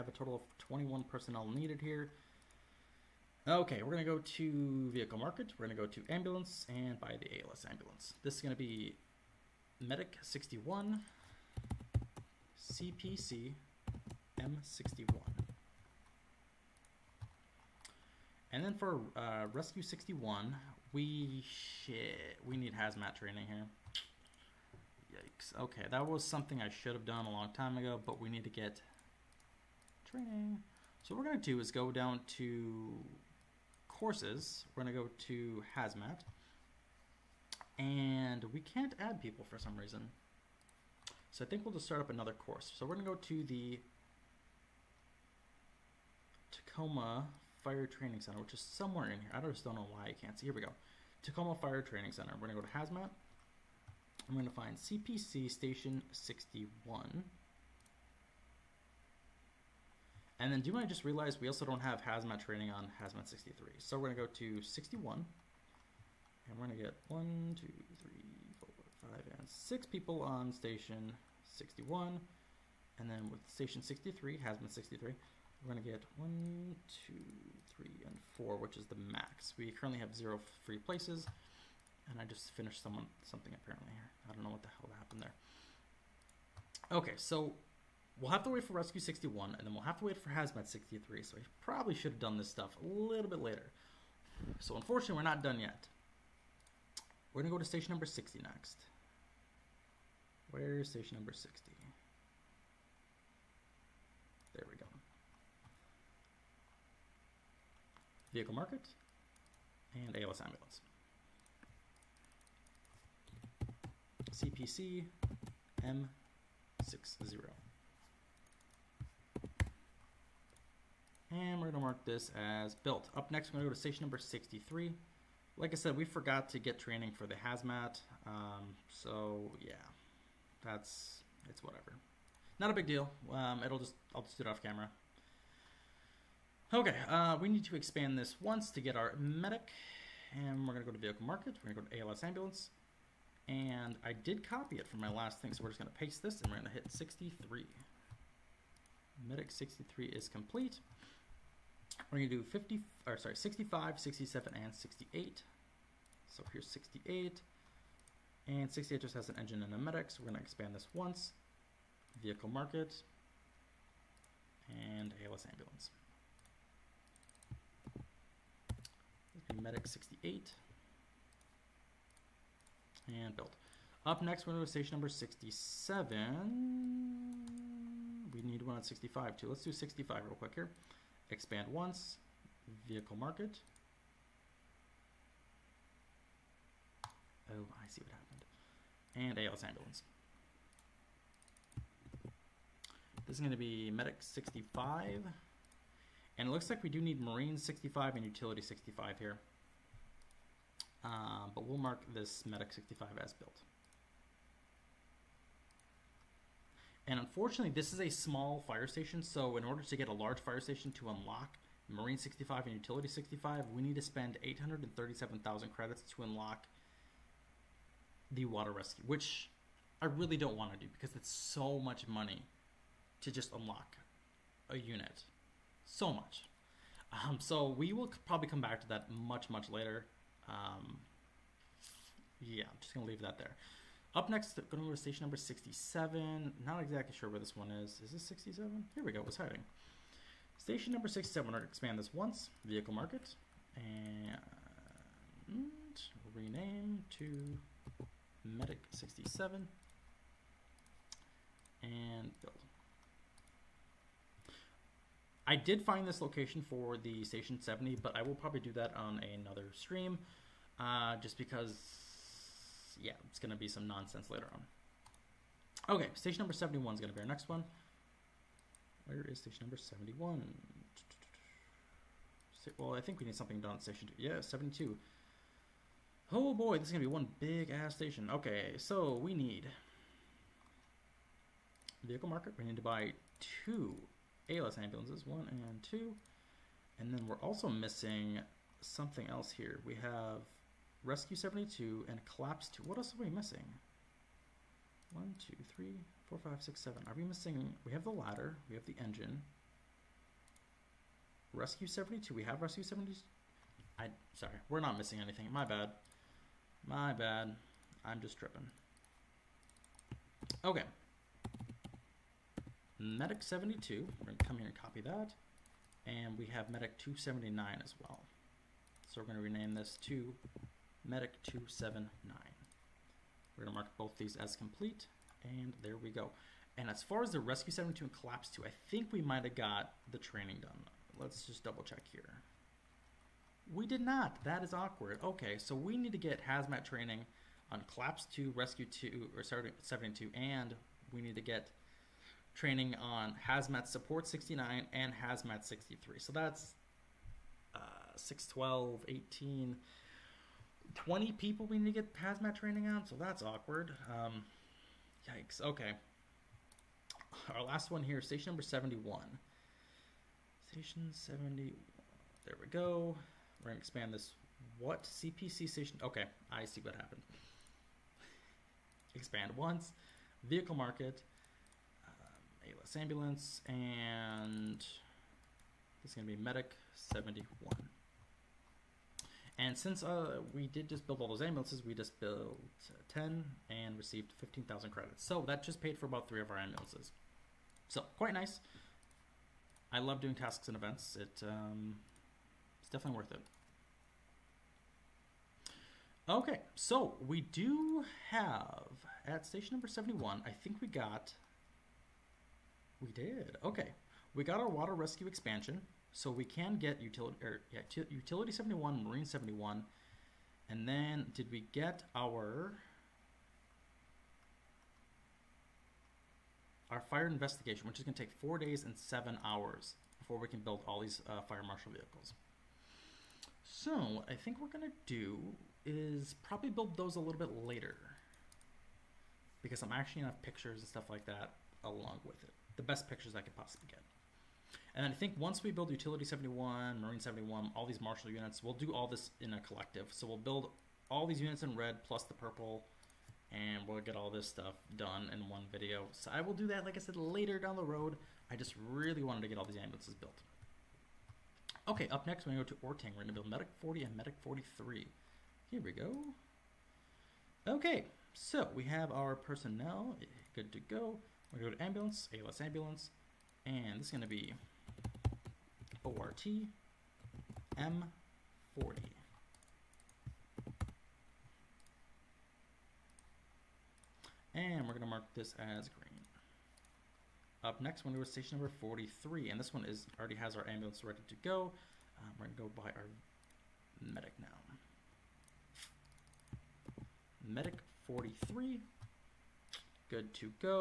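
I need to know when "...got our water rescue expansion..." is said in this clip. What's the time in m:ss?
6:44.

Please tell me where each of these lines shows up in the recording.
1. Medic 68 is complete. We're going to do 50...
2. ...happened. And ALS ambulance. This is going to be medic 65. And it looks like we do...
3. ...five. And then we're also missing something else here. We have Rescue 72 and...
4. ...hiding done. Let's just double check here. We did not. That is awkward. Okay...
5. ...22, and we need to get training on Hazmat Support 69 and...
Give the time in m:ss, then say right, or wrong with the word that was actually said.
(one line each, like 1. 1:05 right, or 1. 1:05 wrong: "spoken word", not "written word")
1. 2:29 wrong: "63", not "68"
2. 3:08 right
3. 4:45 wrong: "two", not "five"
4. 5:30 wrong: "training", not "hiding"
5. 5:39 wrong: "72", not "22".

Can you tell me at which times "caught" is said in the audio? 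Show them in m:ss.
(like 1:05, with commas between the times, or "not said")
not said.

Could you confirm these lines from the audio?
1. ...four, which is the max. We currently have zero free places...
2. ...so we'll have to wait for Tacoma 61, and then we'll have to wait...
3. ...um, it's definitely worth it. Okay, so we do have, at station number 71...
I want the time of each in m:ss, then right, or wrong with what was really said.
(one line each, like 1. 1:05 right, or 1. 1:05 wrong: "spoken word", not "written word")
1. 1:18 right
2. 1:27 wrong: "Rescue", not "Tacoma"
3. 6:31 right.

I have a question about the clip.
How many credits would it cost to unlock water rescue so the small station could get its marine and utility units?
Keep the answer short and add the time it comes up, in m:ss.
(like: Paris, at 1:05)
837,000 credits, at 3:34.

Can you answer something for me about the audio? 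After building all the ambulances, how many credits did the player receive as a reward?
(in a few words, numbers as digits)
15,000 credits.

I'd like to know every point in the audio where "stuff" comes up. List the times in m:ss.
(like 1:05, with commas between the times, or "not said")
1:32, 7:10, 7:24.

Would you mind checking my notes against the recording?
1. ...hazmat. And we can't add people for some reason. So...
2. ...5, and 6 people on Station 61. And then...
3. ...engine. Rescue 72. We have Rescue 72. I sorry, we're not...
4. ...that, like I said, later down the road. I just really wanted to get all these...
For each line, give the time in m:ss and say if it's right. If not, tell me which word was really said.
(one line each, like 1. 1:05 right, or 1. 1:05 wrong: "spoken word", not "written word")
1. 0:35 right
2. 1:09 right
3. 4:59 right
4. 7:26 right.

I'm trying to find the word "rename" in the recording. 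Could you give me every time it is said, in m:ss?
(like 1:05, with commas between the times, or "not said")
4:06, 5:19.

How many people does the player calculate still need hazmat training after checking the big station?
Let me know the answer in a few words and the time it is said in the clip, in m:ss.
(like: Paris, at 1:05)
20, at 5:50.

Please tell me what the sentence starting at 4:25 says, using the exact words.
Okay, station number 71 is going to be our next one.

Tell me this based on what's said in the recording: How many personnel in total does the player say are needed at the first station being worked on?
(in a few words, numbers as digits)
21.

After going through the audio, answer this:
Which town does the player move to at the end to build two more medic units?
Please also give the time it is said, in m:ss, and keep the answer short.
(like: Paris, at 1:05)
Orting, at 7:32.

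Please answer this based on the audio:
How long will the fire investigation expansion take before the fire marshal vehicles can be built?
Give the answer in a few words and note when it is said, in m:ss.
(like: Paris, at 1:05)
4 days and 7 hours, at 6:58.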